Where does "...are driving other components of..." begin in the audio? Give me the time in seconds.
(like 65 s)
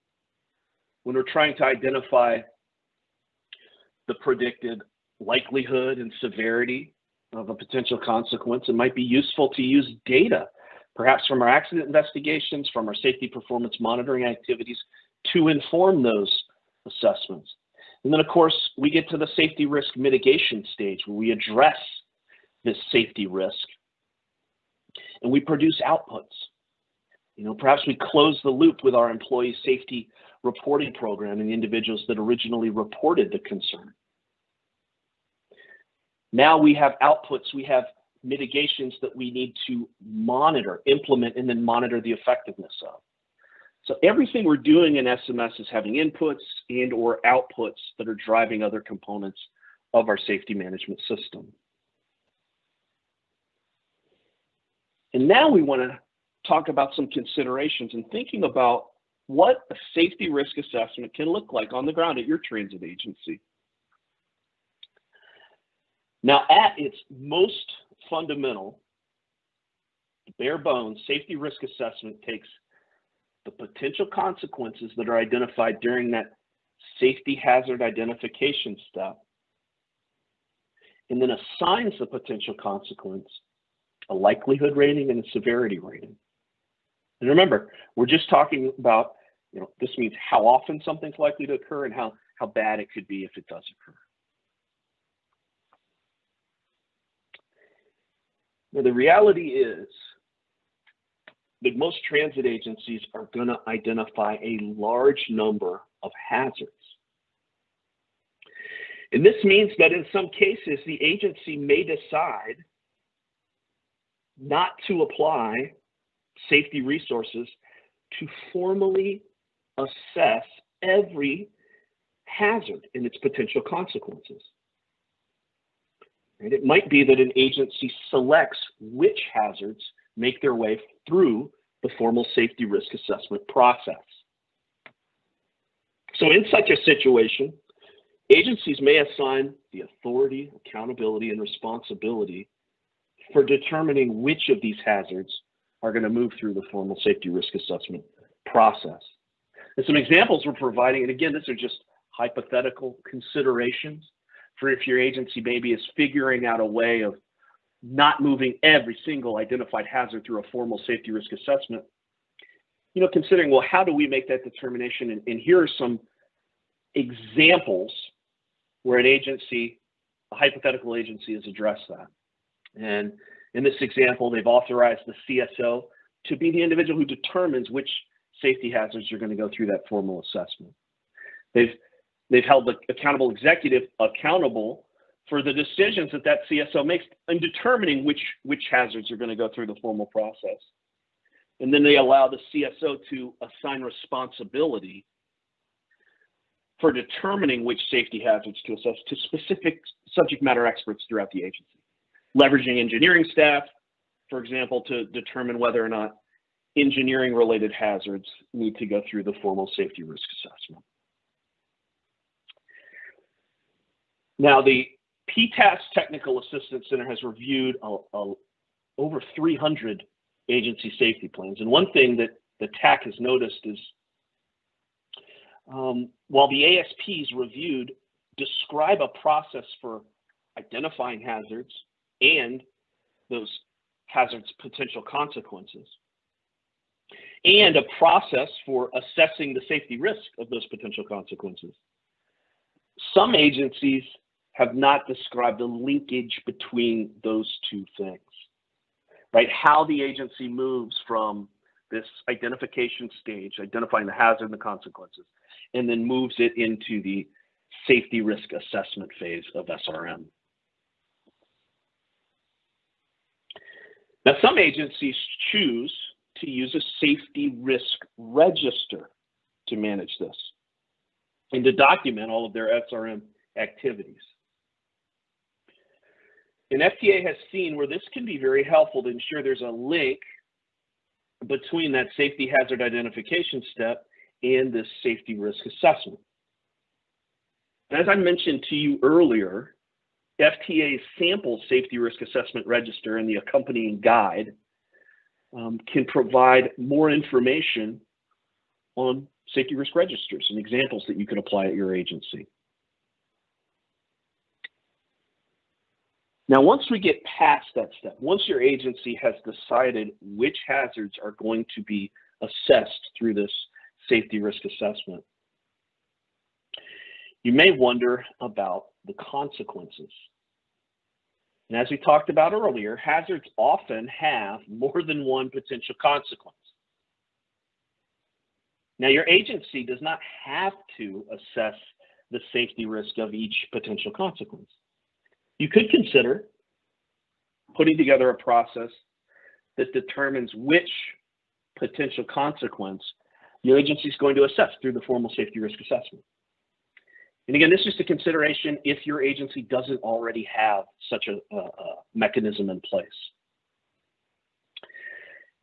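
48 s.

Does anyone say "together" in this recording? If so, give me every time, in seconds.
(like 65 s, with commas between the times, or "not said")
337 s.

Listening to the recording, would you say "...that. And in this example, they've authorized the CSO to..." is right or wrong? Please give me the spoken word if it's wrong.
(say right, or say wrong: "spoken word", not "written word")
right.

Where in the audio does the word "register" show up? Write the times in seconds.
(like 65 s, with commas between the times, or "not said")
268 s, 292 s, 299 s.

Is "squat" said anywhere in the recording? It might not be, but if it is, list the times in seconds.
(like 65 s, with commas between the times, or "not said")
not said.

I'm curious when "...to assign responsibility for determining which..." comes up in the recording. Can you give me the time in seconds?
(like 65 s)
193 s.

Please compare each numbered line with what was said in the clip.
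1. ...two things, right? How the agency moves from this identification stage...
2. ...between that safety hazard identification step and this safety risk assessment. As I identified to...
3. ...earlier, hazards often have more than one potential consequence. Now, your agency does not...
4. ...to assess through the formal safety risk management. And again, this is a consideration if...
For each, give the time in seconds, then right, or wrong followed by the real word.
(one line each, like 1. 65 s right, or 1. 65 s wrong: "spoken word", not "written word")
1. 247 s right
2. 281 s wrong: "mentioned", not "identified"
3. 322 s right
4. 344 s wrong: "assessment", not "management".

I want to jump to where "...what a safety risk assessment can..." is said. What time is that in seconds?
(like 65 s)
59 s.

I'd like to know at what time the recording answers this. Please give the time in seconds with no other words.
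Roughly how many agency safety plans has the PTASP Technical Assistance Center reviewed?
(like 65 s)
218 s.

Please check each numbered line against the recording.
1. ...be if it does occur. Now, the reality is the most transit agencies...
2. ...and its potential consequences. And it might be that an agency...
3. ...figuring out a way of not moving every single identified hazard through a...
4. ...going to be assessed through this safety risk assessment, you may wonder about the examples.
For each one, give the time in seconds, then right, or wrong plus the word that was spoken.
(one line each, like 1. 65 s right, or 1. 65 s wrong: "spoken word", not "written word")
1. 93 s right
2. 122 s right
3. 155 s right
4. 311 s wrong: "consequences", not "examples".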